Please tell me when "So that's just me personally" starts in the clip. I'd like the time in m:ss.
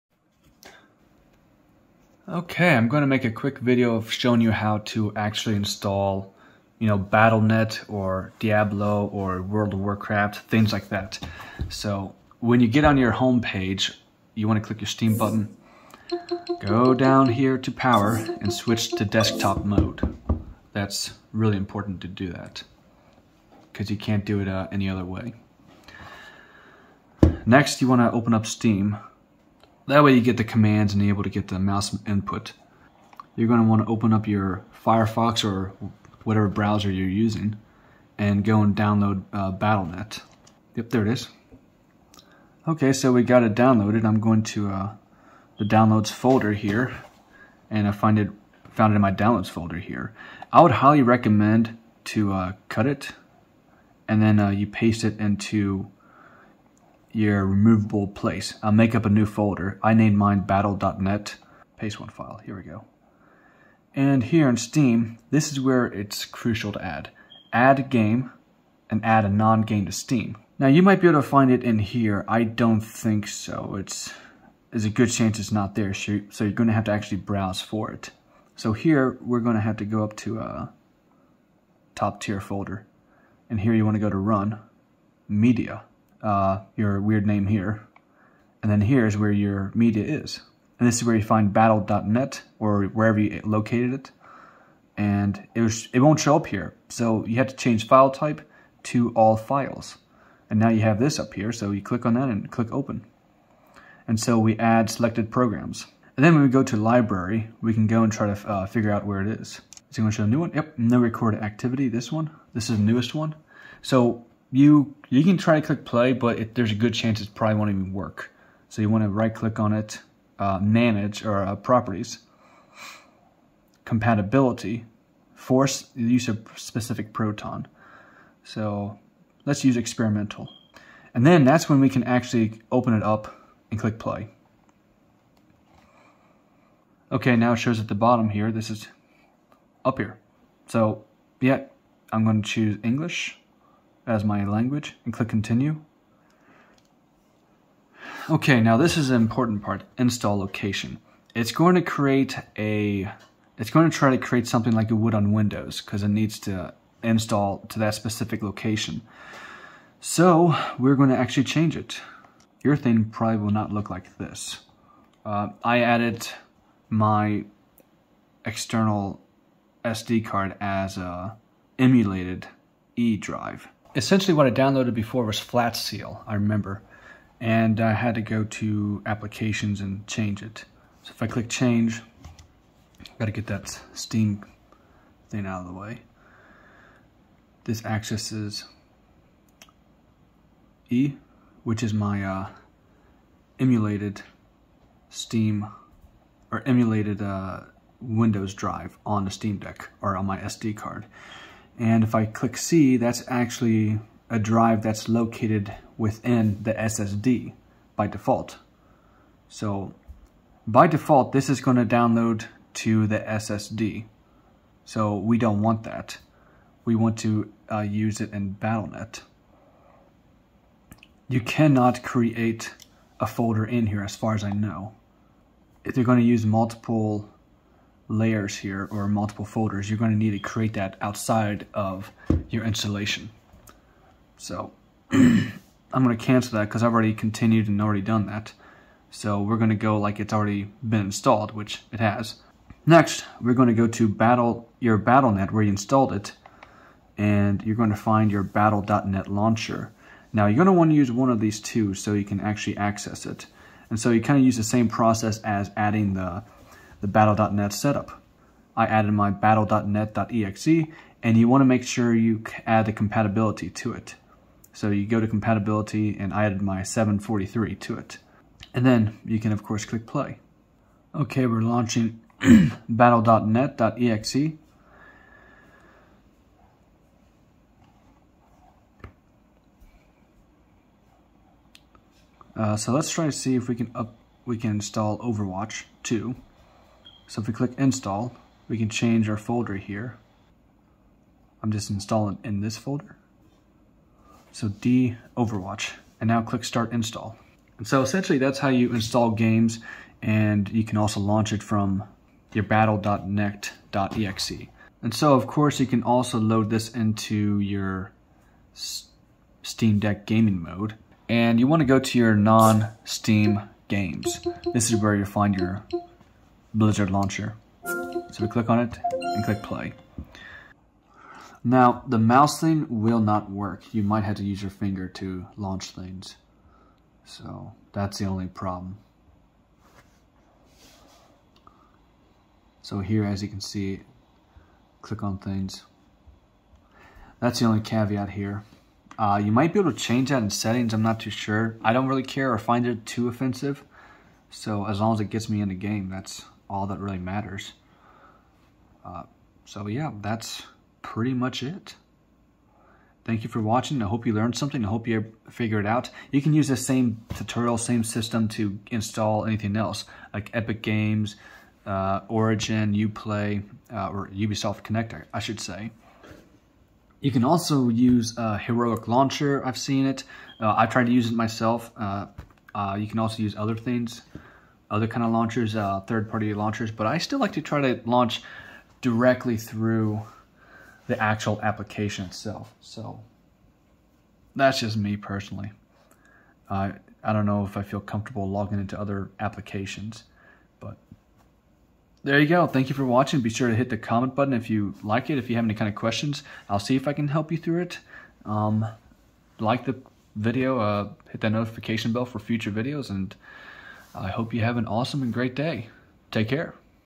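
6:22.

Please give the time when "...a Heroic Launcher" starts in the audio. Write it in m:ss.
6:08.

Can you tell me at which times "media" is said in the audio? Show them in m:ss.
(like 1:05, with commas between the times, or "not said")
1:25, 1:29.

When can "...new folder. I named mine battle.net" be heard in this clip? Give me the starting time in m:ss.
0:59.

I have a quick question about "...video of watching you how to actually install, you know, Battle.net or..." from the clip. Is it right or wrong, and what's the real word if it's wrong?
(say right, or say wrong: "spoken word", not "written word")
wrong: "showing", not "watching".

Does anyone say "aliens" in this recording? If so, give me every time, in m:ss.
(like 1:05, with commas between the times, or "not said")
not said.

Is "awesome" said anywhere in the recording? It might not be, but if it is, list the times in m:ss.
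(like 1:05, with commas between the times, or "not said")
6:44.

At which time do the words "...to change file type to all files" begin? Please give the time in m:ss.
1:37.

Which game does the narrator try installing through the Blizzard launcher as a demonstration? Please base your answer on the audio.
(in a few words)
Overwatch 2.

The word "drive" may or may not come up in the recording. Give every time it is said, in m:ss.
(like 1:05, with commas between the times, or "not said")
2:53, 3:18, 3:24.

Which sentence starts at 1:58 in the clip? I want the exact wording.
So you want to right click on it, uh, manage or uh, properties, compatibility, force the use of specific proton.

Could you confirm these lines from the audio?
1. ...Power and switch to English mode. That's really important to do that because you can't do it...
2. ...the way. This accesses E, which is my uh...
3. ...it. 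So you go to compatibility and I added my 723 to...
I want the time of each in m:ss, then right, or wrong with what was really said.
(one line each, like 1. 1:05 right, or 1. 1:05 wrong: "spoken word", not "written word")
1. 0:17 wrong: "Desktop", not "English"
2. 3:05 right
3. 4:23 wrong: "743", not "723".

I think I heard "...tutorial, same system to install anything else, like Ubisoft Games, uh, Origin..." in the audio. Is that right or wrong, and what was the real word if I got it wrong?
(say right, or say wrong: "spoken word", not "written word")
wrong: "Epic", not "Ubisoft".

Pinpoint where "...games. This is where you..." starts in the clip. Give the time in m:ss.
5:13.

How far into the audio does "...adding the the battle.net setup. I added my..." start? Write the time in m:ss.
4:15.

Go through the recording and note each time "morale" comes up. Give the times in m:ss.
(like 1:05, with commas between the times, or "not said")
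not said.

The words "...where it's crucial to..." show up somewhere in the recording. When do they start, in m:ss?
1:05.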